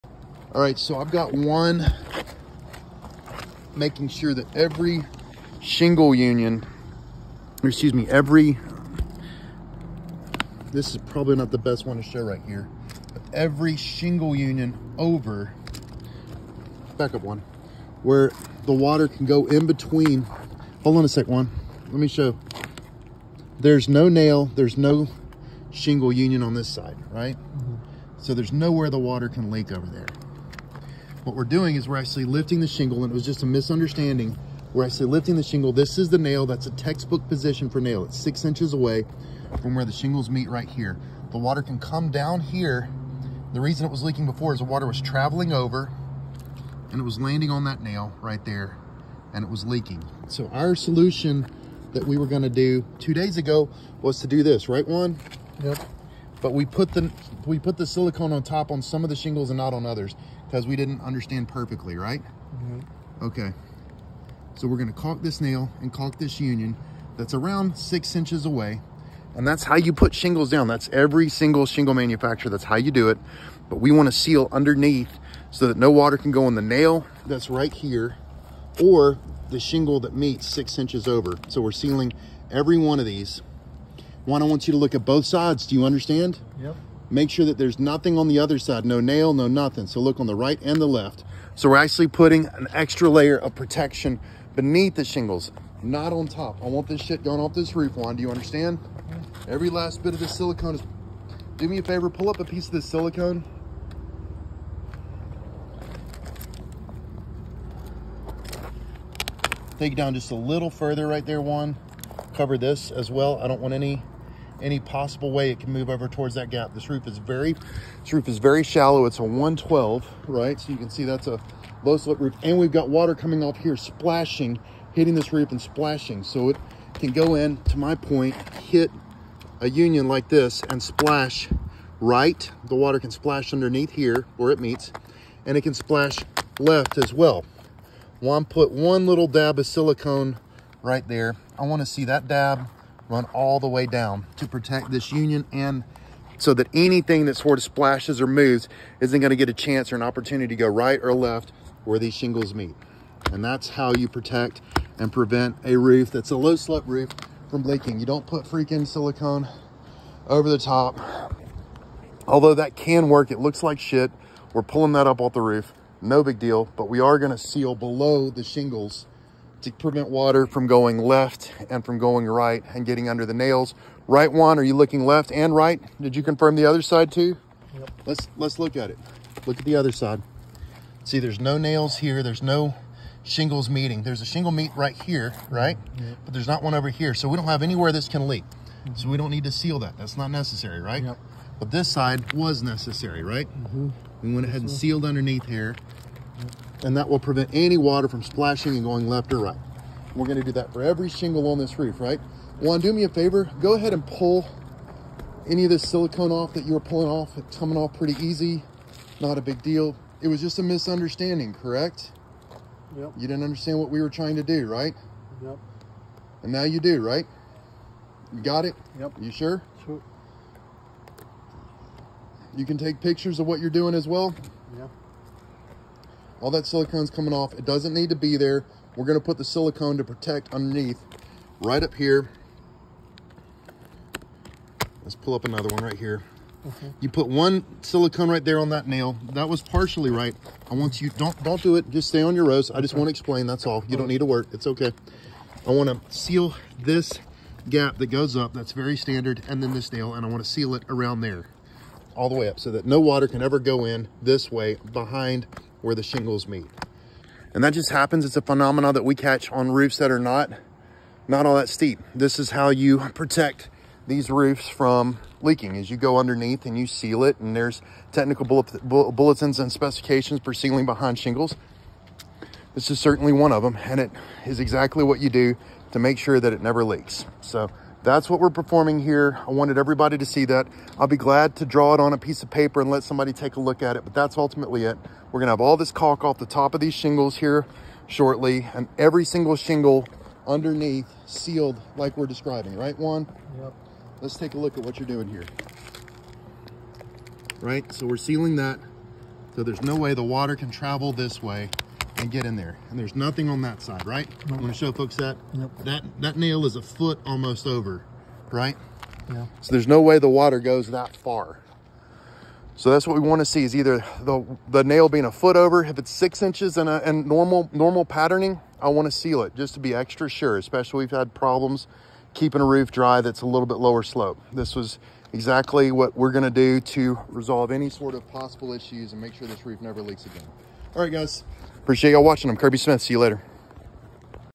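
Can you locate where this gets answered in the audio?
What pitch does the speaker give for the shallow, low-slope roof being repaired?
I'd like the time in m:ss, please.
1:59.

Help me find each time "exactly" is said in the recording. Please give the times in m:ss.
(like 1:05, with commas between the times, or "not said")
4:34, 5:25.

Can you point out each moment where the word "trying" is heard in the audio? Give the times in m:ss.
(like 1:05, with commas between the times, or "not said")
3:34.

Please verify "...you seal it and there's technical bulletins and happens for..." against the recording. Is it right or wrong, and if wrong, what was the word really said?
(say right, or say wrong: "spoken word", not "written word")
wrong: "specifications", not "happens".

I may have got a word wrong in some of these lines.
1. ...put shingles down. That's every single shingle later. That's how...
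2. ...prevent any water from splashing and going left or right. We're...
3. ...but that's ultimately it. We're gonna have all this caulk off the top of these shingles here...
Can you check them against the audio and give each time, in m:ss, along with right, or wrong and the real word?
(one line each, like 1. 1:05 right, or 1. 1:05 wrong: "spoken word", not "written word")
1. 1:09 wrong: "manufacturer", not "later"
2. 3:17 right
3. 4:44 right.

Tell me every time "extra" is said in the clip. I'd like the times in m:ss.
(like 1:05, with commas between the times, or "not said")
1:32, 5:19.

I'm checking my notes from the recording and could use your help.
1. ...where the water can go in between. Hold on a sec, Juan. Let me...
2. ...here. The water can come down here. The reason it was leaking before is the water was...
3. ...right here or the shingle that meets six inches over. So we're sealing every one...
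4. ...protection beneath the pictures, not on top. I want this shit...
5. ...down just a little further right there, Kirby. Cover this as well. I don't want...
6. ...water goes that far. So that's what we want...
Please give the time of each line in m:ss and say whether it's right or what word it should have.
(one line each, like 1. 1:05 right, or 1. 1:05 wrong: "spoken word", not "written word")
1. 0:18 right
2. 0:40 right
3. 1:17 right
4. 1:33 wrong: "shingles", not "pictures"
5. 1:49 wrong: "Juan", not "Kirby"
6. 5:10 right.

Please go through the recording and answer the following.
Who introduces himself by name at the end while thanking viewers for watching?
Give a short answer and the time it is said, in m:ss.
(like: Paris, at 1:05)
Kirby Smith, at 5:32.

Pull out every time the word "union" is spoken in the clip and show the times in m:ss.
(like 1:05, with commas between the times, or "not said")
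0:06, 0:14, 0:26, 1:06, 2:09, 2:25.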